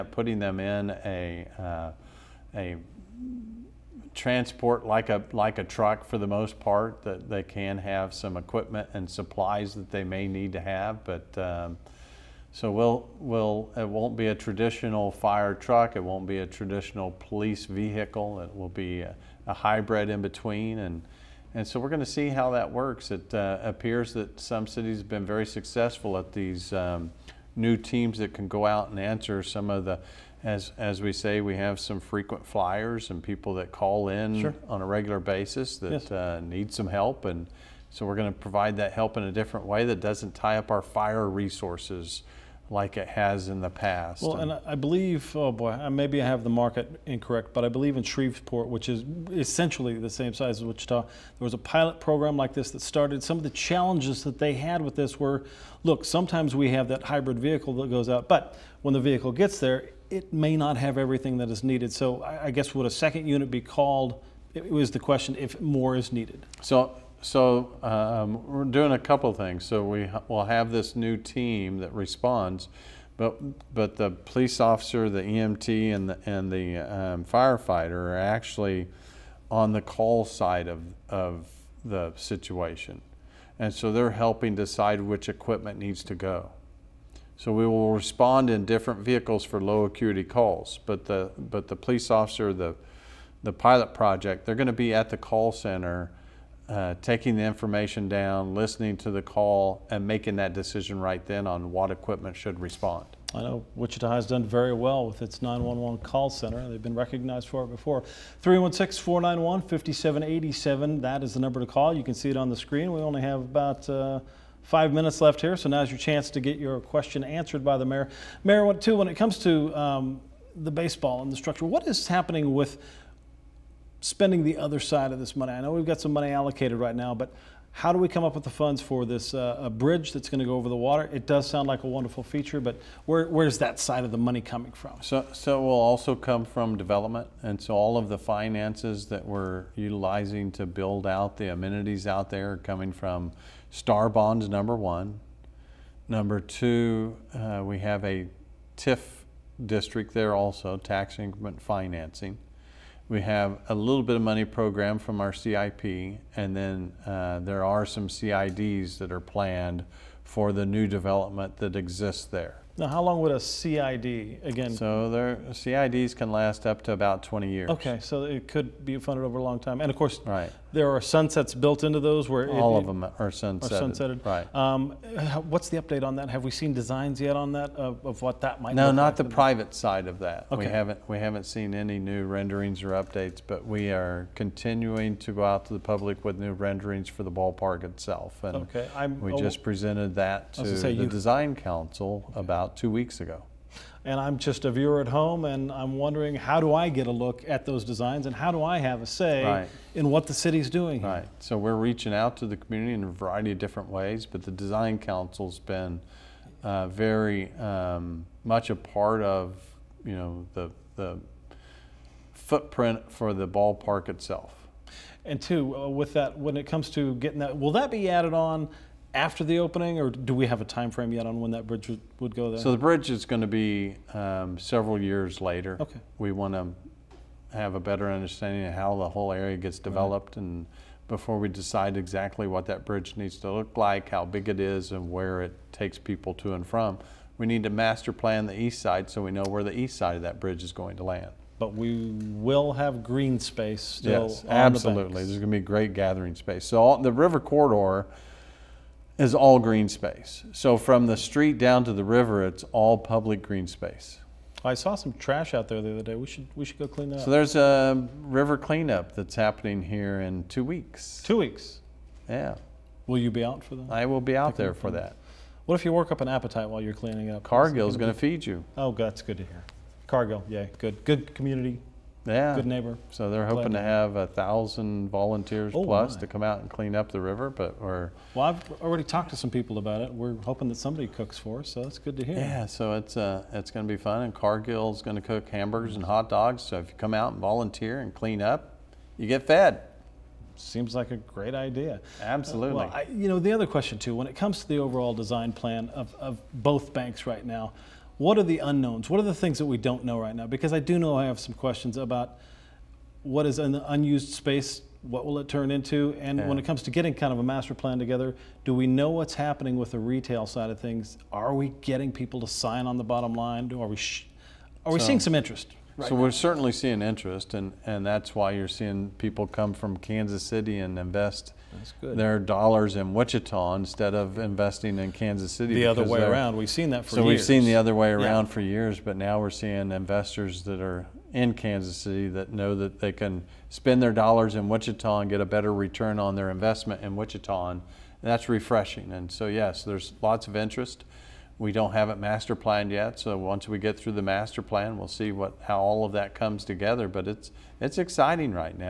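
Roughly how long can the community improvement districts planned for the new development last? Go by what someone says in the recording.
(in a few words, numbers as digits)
20 years.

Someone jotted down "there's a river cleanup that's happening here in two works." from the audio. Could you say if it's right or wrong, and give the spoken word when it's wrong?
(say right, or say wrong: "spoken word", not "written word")
wrong: "weeks", not "works".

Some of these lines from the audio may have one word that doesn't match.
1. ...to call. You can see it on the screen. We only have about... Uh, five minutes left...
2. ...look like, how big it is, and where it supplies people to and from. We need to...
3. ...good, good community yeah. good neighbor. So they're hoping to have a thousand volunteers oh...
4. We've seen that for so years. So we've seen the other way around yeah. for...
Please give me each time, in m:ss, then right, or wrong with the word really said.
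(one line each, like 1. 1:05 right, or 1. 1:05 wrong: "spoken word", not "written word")
1. 1:51 right
2. 3:53 wrong: "takes", not "supplies"
3. 4:30 right
4. 5:26 right.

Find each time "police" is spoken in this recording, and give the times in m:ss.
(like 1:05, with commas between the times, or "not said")
0:17, 1:14, 1:31.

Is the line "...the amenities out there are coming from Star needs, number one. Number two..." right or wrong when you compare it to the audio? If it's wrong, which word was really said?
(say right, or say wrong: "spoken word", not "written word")
wrong: "bonds", not "needs".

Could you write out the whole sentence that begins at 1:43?
I know Wichita has done very well with its 911 call center.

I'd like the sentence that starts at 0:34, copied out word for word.
on a regular basis that yes.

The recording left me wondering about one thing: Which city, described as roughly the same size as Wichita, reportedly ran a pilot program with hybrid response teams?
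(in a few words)
Shreveport.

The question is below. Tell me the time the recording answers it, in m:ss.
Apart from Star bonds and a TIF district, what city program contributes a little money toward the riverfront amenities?
2:35.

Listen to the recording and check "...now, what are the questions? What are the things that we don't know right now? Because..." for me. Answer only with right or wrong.
wrong.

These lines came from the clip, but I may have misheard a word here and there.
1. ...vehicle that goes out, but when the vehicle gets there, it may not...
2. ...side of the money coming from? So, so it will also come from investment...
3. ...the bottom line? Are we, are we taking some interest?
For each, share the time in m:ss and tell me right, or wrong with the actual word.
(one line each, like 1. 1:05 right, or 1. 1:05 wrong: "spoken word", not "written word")
1. 0:57 right
2. 2:13 wrong: "development", not "investment"
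3. 5:12 wrong: "seeing", not "taking".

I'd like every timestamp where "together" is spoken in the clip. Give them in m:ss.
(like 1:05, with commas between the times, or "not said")
5:07, 5:46.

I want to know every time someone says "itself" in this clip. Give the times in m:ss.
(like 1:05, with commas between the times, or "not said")
3:07, 3:34.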